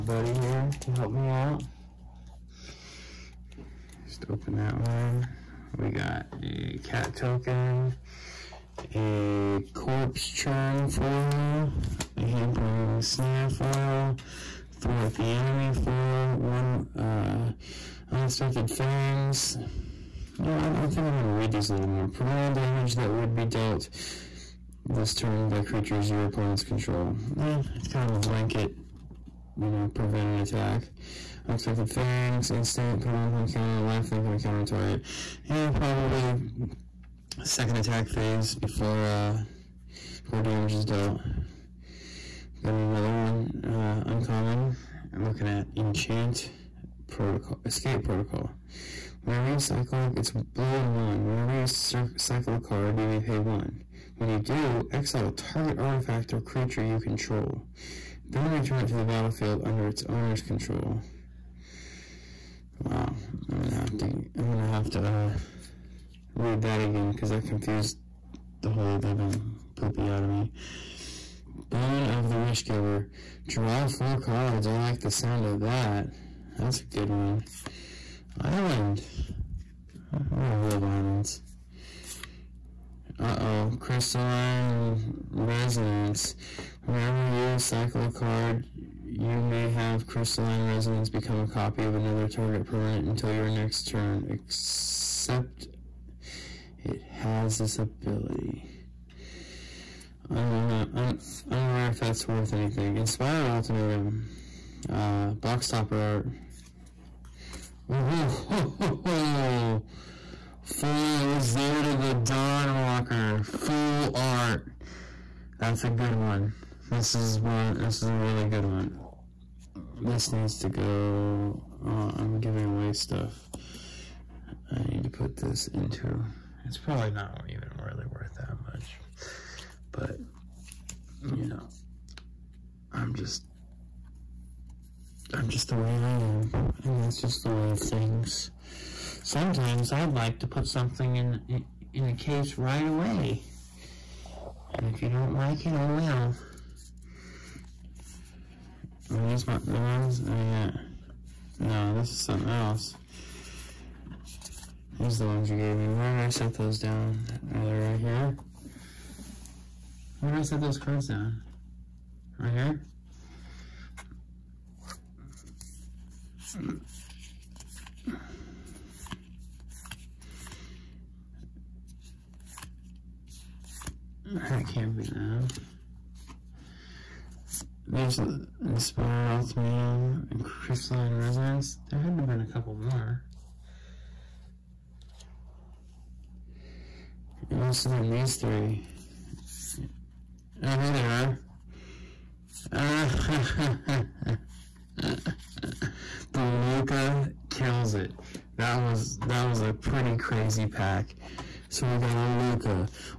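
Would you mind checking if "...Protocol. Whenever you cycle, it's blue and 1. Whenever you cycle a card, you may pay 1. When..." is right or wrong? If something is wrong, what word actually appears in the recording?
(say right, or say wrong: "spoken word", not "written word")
right.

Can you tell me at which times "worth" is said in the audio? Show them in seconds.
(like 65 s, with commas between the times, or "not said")
102 s, 128 s.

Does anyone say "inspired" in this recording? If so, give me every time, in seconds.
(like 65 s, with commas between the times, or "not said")
102 s, 178 s.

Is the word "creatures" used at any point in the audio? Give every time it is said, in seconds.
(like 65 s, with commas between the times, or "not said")
25 s, 56 s.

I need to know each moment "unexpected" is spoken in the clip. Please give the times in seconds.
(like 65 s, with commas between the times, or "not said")
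18 s, 31 s.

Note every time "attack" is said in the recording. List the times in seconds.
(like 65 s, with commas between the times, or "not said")
30 s, 37 s.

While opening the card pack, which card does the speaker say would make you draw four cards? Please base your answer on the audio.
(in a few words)
Boon of the Wish Giver.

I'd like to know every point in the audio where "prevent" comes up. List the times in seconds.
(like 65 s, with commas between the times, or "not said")
22 s, 29 s.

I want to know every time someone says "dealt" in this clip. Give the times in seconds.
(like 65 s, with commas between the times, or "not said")
23 s, 40 s.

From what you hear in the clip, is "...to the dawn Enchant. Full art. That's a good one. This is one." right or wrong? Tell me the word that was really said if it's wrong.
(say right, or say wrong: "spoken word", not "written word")
wrong: "Walker", not "Enchant".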